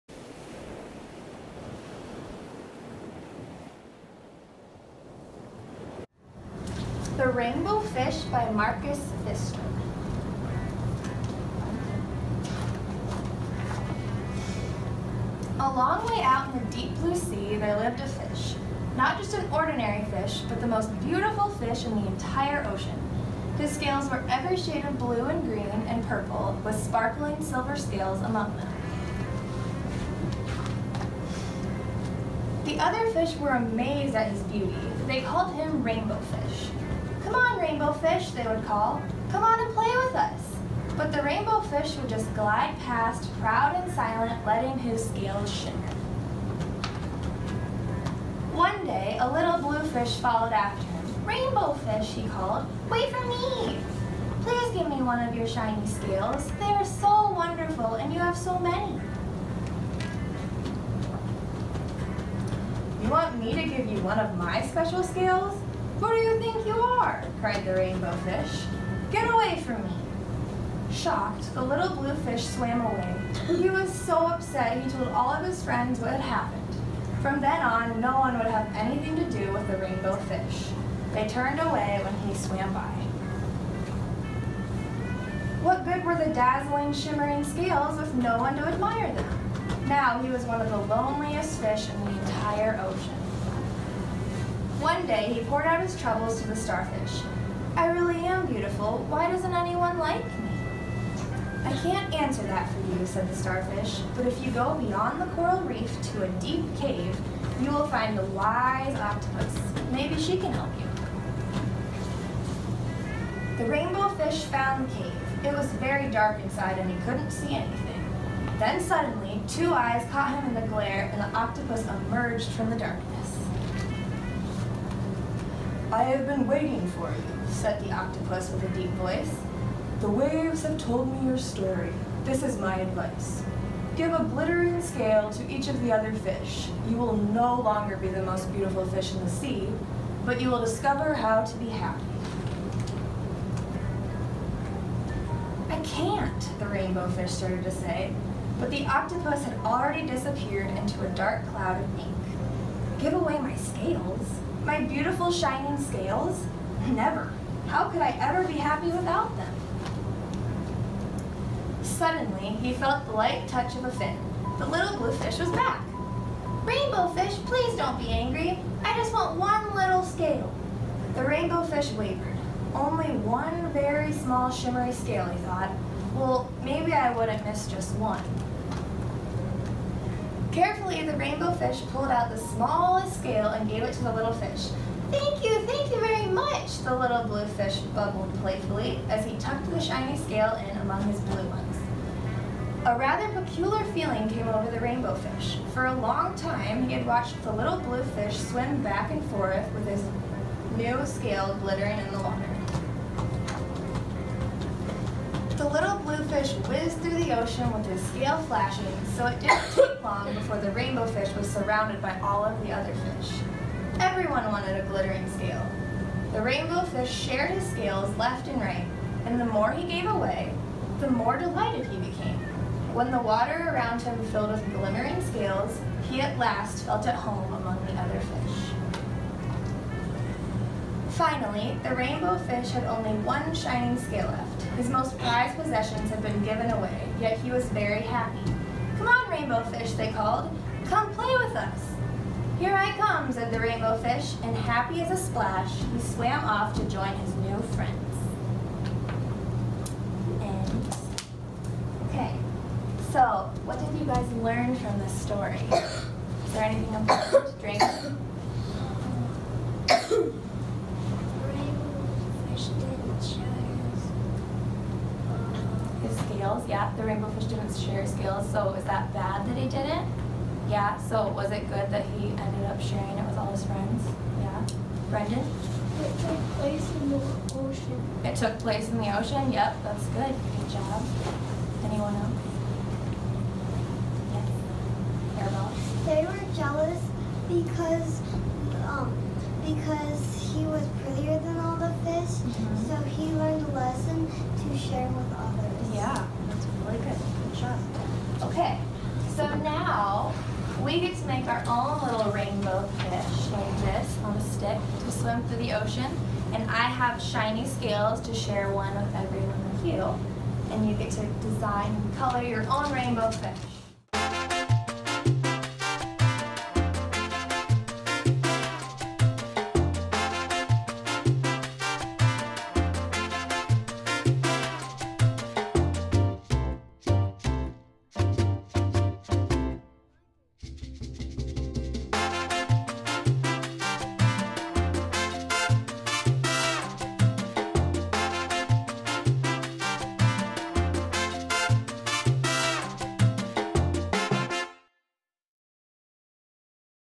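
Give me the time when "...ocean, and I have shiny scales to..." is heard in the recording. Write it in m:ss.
5:05.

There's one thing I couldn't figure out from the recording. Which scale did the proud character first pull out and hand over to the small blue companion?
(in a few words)
the smallest scale.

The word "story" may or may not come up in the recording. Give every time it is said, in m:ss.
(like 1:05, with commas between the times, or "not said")
2:11, 4:15.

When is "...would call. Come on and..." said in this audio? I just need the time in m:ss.
0:38.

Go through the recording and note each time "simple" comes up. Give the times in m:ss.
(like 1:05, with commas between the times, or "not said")
not said.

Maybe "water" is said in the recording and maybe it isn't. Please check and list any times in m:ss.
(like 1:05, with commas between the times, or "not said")
3:22, 3:43.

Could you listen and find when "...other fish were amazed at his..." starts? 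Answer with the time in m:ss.
0:32.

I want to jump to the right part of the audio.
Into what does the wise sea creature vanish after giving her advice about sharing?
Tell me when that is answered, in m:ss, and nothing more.
2:31.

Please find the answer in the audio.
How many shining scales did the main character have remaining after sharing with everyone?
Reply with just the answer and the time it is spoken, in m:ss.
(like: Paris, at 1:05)
1, at 3:52.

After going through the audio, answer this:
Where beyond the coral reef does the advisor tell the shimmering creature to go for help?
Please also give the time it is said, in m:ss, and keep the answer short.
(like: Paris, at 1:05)
a deep cave, at 1:46.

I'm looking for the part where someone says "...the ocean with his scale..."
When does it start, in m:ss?
3:27.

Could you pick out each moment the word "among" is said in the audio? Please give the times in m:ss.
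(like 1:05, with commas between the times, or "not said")
0:28, 3:10, 3:47.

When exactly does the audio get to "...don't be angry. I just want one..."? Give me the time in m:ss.
2:47.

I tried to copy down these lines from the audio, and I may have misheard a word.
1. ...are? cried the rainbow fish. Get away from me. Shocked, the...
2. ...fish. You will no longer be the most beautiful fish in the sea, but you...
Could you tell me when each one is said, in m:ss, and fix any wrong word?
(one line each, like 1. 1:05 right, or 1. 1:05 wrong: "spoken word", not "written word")
1. 1:06 right
2. 2:16 right.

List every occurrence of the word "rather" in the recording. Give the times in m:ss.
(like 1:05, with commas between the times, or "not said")
3:12.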